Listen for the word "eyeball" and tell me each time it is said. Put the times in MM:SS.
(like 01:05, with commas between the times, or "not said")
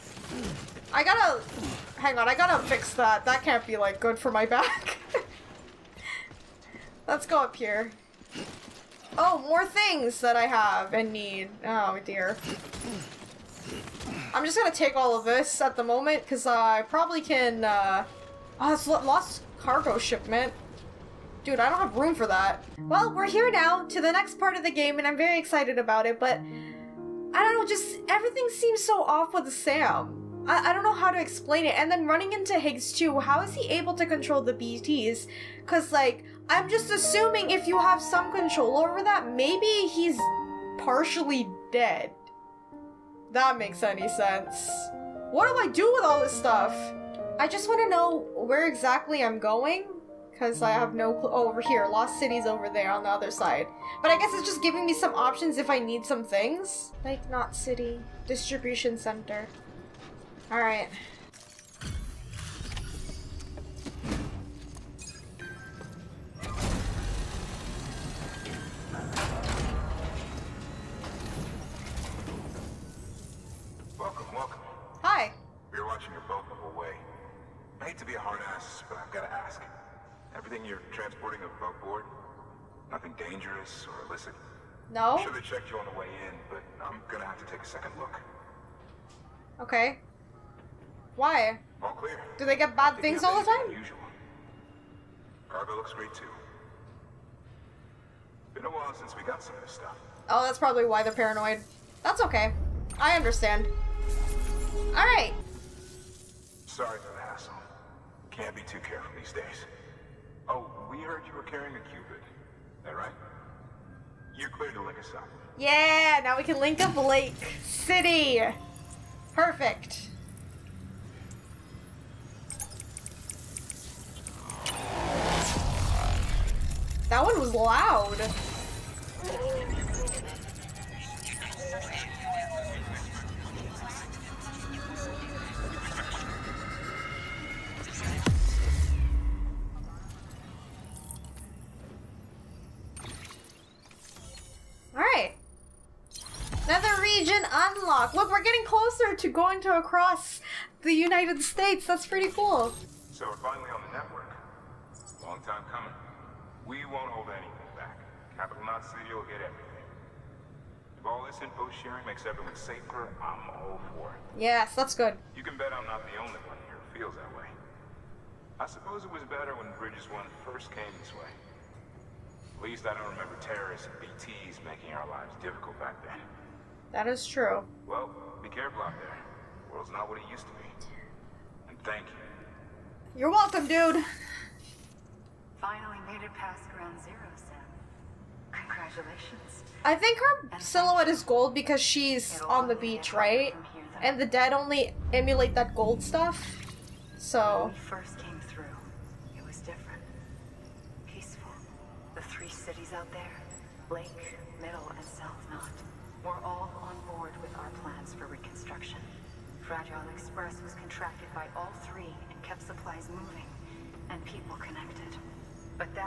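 not said.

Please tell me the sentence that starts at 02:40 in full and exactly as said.
If all this info sharing makes everyone safer, I'm all for it.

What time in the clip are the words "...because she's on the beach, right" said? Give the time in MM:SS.
03:11.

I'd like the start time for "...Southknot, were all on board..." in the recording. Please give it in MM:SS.
03:25.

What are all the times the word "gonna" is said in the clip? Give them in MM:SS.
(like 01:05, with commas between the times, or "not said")
00:14, 01:27.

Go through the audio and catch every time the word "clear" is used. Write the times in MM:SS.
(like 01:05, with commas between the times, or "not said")
01:31, 01:54.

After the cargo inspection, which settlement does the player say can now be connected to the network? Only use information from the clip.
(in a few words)
Lake City.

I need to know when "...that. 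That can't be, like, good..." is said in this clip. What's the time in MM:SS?
00:02.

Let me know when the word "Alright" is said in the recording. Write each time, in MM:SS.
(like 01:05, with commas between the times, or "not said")
01:00, 01:44, 02:24.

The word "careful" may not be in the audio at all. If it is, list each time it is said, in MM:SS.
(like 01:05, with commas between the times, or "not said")
01:48, 02:58.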